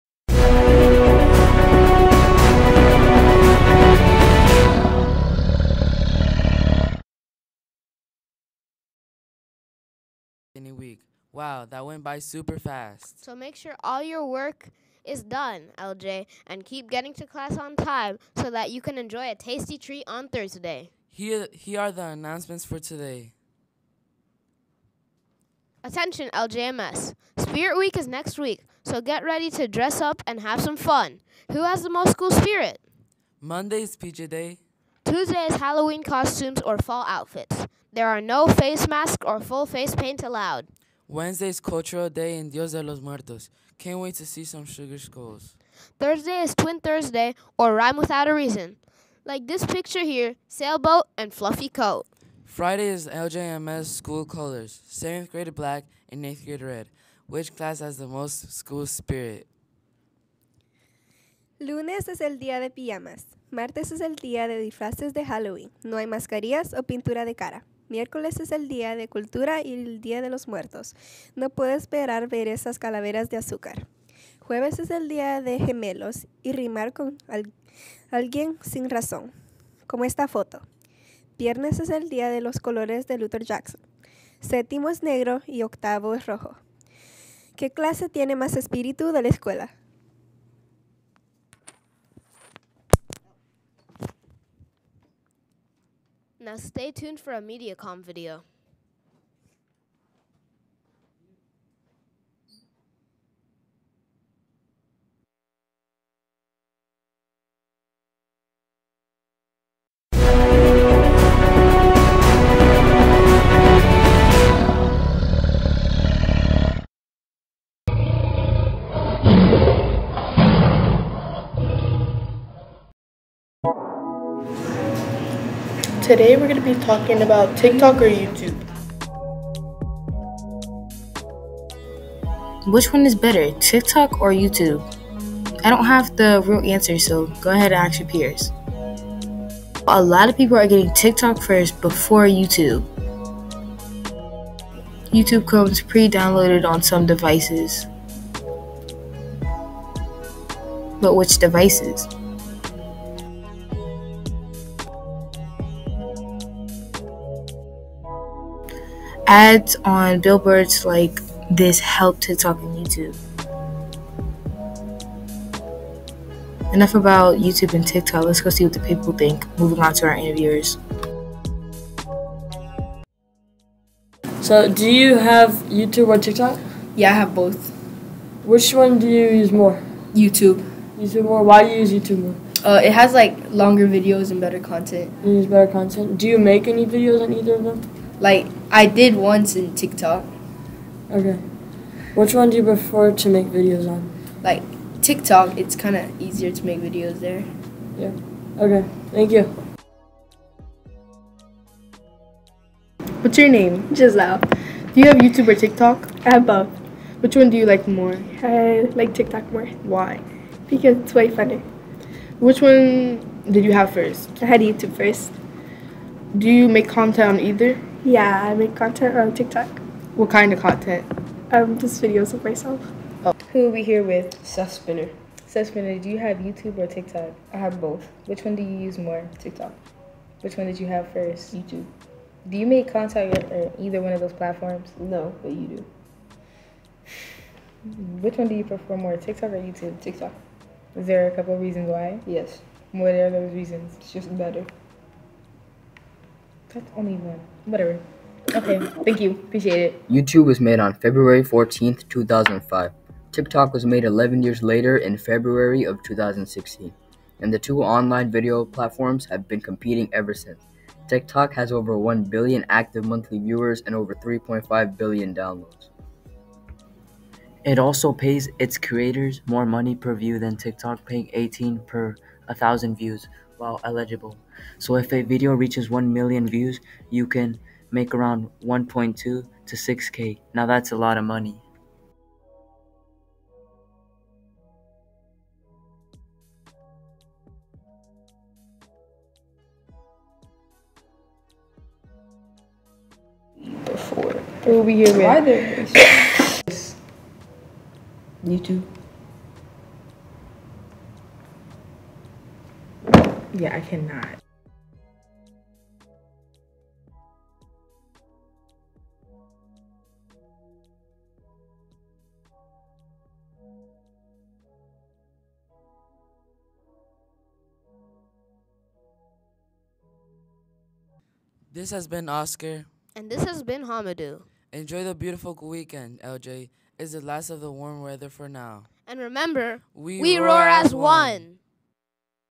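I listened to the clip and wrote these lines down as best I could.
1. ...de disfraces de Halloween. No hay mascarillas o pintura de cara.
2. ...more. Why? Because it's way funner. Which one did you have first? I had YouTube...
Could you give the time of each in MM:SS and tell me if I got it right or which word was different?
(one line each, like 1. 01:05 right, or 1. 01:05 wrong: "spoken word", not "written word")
1. 01:04 right
2. 03:29 right.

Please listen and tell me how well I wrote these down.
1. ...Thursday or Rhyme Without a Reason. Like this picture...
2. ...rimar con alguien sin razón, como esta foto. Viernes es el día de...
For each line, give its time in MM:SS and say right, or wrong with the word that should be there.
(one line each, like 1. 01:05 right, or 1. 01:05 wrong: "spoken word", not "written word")
1. 00:46 right
2. 01:16 right.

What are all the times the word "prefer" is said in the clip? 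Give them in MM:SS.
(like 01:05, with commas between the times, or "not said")
03:12, 03:58.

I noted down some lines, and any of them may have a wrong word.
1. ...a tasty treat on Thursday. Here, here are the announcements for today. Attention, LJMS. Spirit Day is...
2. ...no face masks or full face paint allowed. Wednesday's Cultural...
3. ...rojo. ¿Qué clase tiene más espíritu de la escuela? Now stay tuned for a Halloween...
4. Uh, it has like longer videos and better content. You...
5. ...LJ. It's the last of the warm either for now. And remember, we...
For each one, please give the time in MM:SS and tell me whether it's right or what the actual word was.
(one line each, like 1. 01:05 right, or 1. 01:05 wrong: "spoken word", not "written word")
1. 00:19 wrong: "Week", not "Day"
2. 00:38 right
3. 01:26 wrong: "MediaCom", not "Halloween"
4. 03:02 right
5. 05:26 wrong: "weather", not "either".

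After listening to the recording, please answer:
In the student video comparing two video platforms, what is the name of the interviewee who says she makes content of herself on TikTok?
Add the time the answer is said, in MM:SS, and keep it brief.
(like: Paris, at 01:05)
Giselle, at 03:23.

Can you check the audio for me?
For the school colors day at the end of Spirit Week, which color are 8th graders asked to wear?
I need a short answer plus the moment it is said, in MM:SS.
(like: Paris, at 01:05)
red, at 00:56.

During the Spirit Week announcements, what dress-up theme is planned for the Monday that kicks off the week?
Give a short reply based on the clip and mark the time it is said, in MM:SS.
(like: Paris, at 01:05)
PJ Day, at 00:33.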